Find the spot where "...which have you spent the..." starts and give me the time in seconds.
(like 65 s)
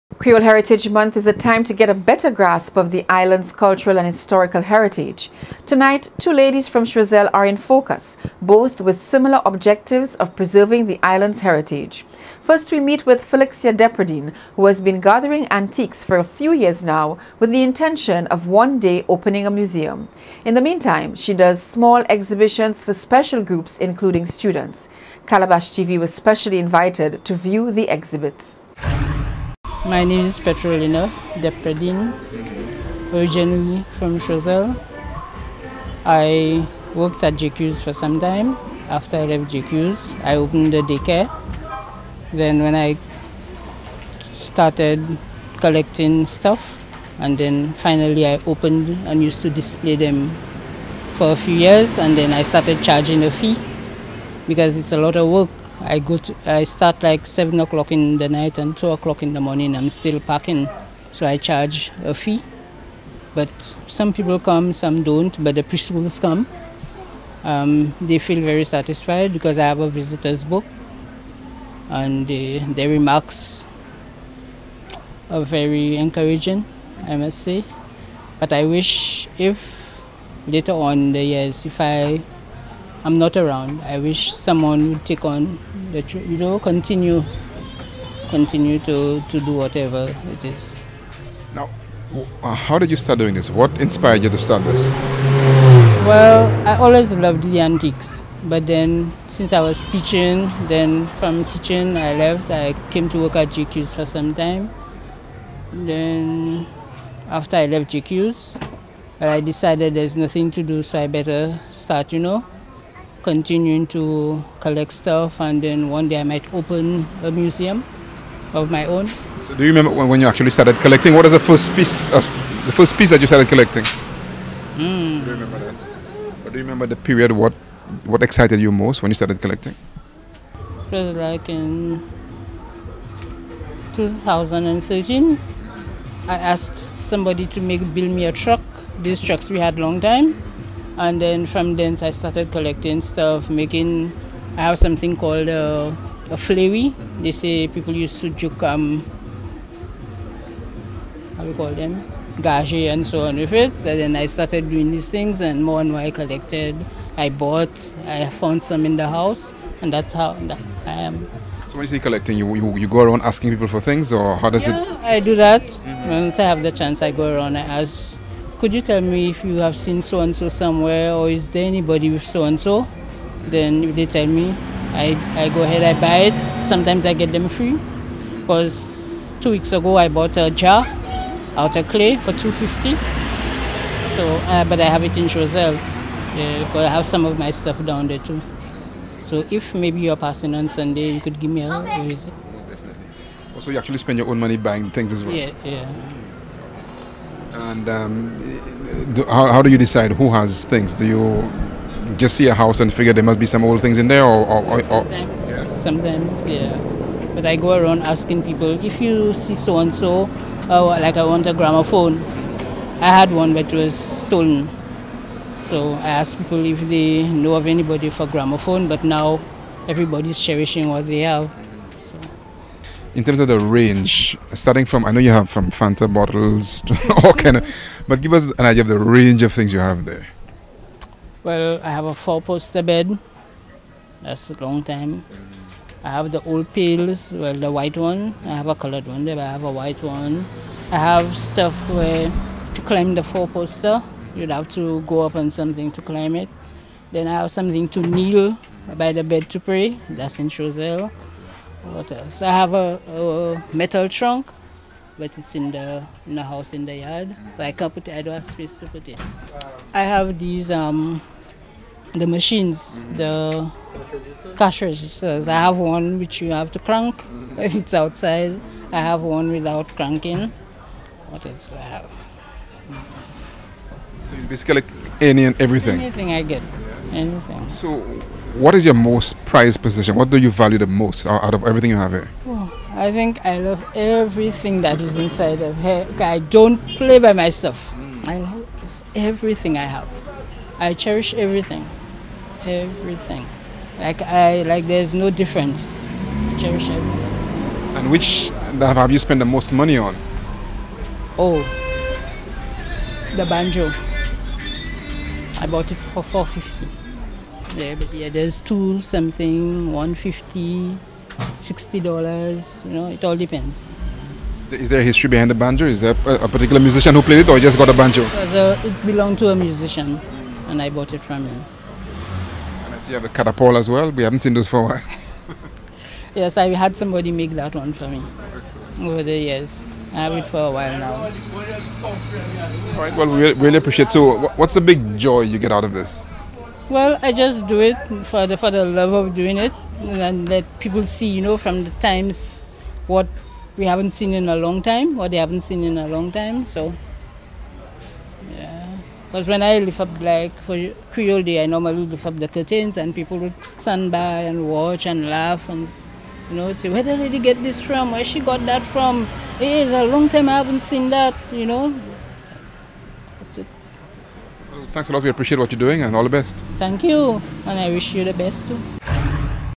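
298 s.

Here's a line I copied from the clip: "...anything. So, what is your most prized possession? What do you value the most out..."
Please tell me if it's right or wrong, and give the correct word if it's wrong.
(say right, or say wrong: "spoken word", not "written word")
right.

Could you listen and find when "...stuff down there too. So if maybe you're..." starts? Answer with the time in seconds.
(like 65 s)
187 s.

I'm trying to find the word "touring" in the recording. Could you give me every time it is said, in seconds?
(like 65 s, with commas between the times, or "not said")
not said.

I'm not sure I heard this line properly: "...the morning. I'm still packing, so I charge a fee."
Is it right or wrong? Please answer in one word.
right.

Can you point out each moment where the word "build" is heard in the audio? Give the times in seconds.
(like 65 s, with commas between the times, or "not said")
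137 s.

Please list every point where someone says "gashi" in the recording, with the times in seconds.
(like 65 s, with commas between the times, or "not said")
152 s.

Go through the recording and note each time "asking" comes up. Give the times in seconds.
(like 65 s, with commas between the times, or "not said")
163 s, 208 s.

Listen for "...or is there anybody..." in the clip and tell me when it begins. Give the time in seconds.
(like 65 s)
171 s.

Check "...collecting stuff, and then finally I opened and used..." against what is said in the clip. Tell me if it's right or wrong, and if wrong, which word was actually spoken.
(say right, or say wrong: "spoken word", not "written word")
right.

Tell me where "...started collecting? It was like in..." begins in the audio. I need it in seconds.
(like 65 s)
129 s.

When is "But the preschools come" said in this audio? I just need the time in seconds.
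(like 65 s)
65 s.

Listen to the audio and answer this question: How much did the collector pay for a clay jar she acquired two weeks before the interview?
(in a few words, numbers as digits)
250.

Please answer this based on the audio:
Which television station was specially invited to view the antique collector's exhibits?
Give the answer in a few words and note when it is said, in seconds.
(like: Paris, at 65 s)
Calabash TV, at 25 s.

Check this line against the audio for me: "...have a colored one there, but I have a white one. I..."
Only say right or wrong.
right.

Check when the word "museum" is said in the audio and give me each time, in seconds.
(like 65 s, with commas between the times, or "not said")
19 s, 117 s.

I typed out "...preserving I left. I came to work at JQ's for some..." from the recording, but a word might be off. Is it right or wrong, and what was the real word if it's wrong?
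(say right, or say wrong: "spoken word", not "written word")
wrong: "teaching", not "preserving".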